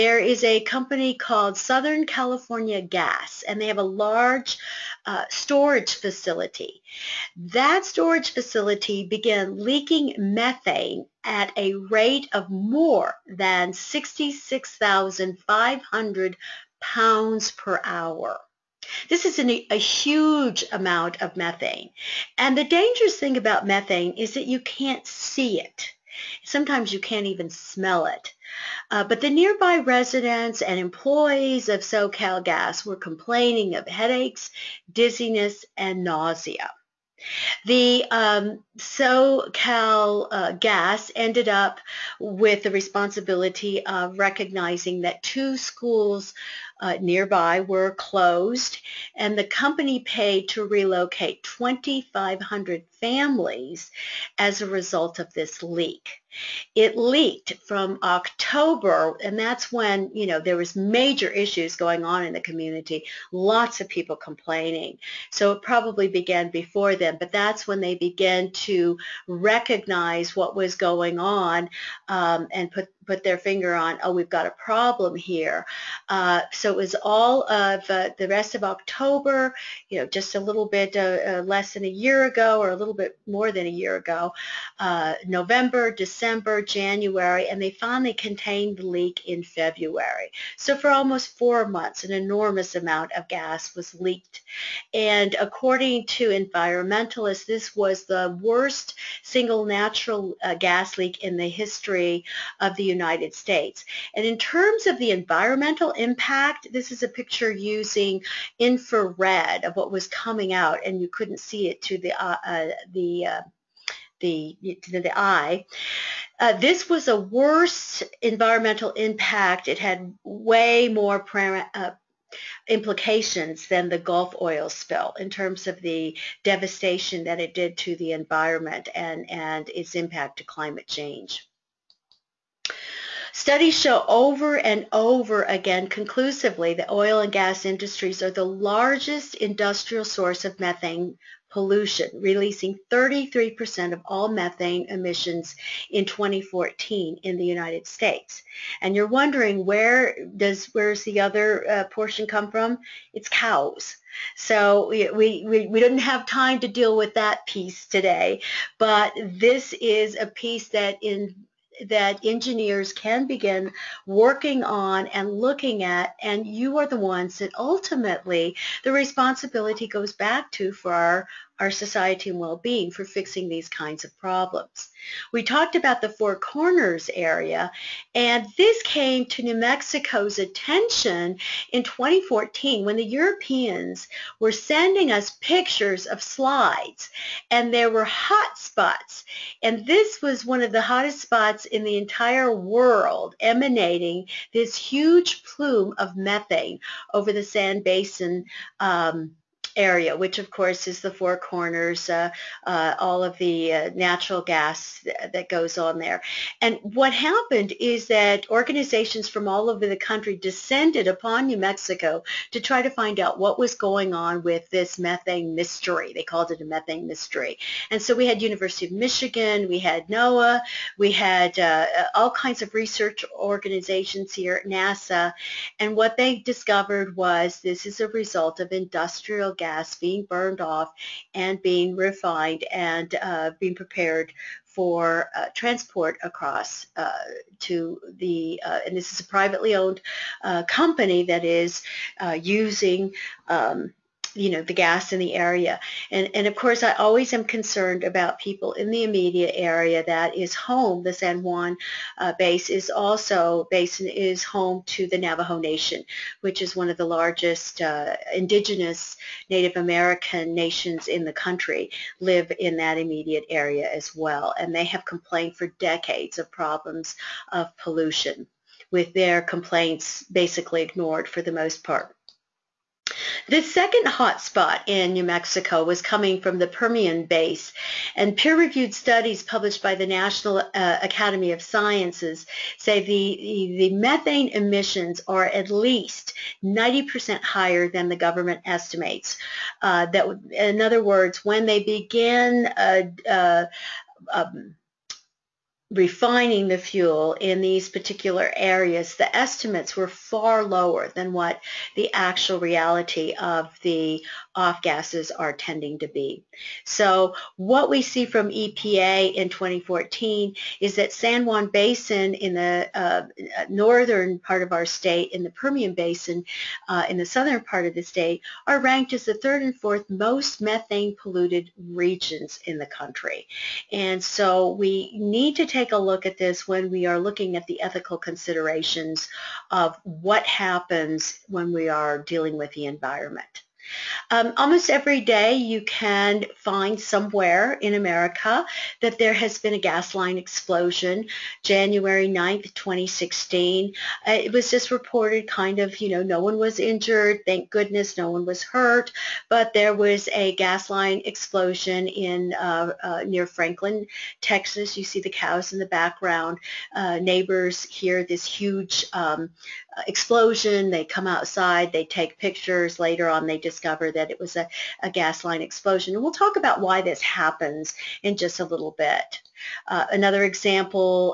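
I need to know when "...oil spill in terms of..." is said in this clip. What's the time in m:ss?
2:04.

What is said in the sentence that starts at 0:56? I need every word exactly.
It leaked from October, and that's when, you know, there was major issues going on in the community, lots of people complaining.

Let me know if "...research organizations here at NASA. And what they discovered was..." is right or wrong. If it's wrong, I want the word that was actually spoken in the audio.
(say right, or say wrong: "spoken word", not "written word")
right.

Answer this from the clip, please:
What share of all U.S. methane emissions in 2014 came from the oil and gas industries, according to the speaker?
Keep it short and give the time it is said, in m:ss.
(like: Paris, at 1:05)
33%, at 2:22.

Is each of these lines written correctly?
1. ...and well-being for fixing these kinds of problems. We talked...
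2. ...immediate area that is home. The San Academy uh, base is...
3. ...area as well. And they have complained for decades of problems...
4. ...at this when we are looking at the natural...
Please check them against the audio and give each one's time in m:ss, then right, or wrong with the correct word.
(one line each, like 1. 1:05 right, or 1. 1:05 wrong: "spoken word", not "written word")
1. 2:52 right
2. 4:09 wrong: "Juan", not "Academy"
3. 4:23 right
4. 5:26 wrong: "ethical", not "natural".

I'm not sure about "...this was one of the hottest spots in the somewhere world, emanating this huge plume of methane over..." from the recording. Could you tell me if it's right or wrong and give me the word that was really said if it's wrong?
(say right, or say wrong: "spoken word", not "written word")
wrong: "entire", not "somewhere".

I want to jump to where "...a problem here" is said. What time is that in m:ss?
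1:14.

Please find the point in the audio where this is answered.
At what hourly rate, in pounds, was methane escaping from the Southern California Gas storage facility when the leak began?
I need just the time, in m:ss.
0:13.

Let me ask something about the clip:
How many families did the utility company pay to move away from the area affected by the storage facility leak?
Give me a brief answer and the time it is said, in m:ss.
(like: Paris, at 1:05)
2,500, at 0:51.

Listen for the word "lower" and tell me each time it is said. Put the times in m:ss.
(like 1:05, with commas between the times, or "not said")
5:00.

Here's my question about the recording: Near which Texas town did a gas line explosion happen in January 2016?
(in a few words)
Franklin.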